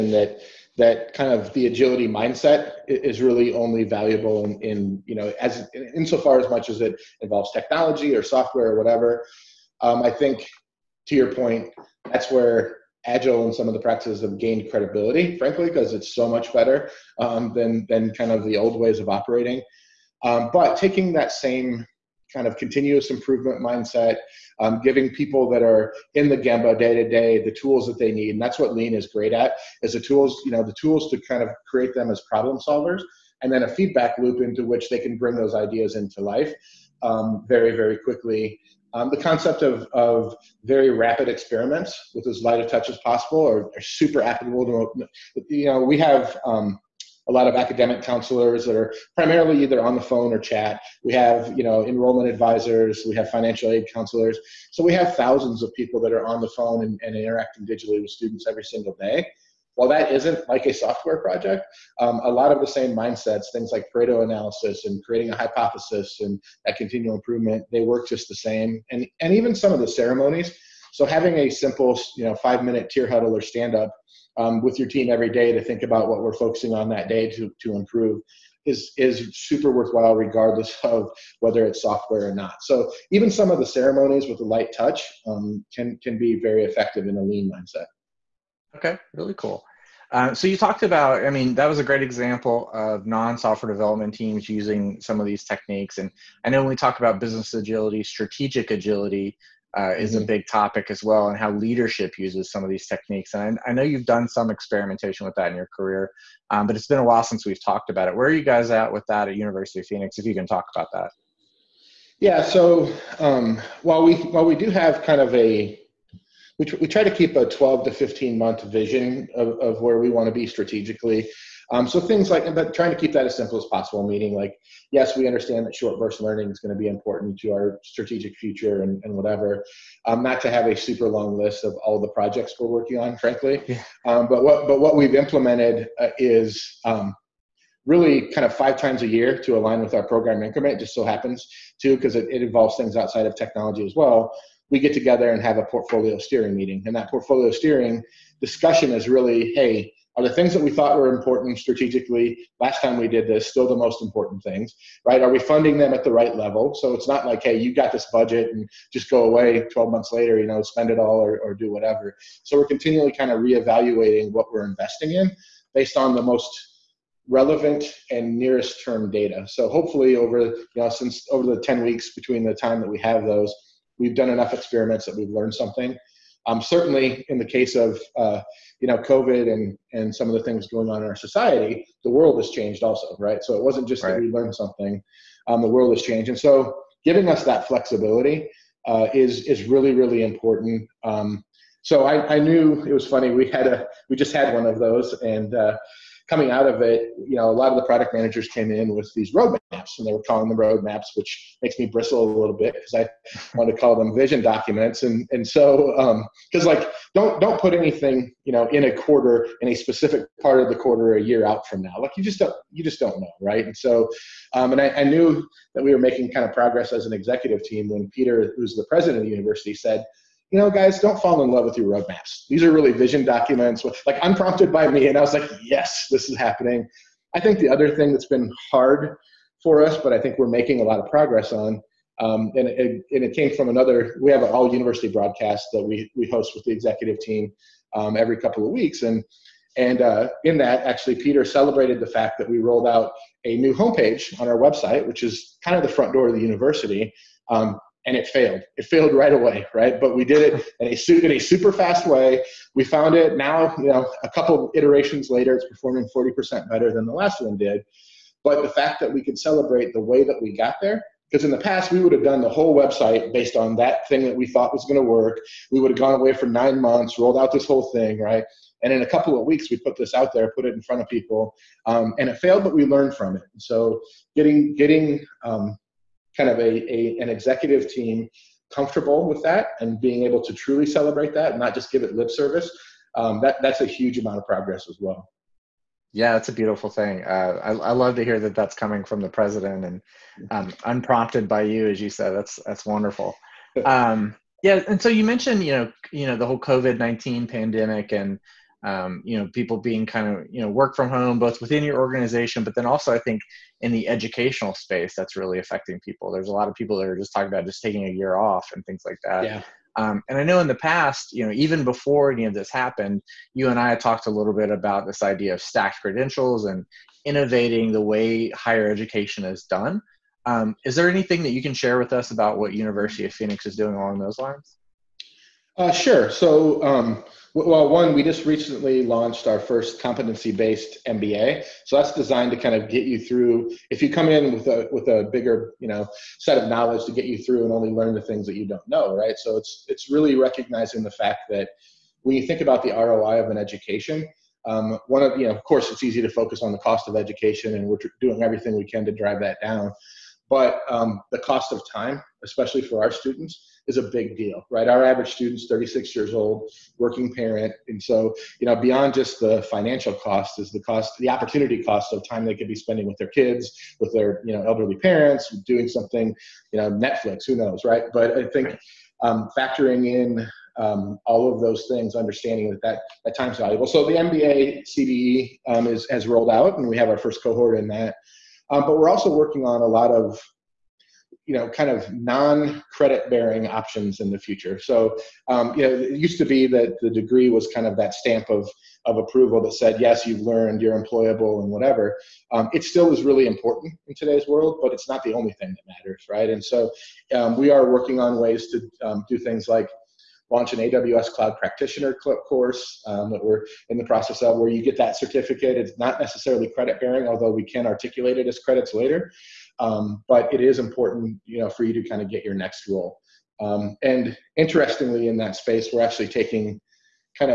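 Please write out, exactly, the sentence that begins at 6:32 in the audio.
Um, it still is really important in today's world, but it's not the only thing that matters, right?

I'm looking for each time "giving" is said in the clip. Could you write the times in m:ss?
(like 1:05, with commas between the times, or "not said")
0:24, 3:07.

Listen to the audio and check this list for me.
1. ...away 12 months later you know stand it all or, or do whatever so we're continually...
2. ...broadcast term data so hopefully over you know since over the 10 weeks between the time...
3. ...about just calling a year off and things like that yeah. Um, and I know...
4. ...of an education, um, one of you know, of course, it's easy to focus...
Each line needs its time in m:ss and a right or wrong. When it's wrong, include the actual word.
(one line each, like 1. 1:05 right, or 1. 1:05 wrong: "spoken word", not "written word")
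1. 2:39 wrong: "spend", not "stand"
2. 2:48 wrong: "nearest", not "broadcast"
3. 5:07 wrong: "taking", not "calling"
4. 5:43 right.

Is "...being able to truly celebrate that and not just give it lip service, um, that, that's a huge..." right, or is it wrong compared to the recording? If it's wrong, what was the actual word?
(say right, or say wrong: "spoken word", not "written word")
right.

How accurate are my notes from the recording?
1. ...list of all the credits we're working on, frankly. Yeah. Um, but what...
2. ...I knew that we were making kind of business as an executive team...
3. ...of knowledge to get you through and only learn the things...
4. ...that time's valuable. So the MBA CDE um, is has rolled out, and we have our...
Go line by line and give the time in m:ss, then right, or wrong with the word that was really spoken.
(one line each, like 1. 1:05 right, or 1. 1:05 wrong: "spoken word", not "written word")
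1. 2:11 wrong: "projects", not "credits"
2. 3:35 wrong: "progress", not "business"
3. 5:36 right
4. 6:13 right.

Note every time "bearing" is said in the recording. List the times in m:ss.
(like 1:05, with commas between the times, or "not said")
6:23, 6:47.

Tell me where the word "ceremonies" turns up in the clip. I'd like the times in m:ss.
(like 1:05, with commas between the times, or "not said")
1:09, 1:23.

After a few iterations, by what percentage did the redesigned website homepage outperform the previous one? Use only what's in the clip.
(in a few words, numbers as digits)
40%.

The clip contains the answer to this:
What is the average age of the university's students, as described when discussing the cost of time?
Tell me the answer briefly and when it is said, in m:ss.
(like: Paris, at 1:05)
36, at 5:55.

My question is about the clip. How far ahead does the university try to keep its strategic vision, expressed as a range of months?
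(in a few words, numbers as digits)
12 to 15 months.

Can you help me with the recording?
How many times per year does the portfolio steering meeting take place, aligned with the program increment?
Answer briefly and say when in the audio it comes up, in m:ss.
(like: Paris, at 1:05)
5, at 2:18.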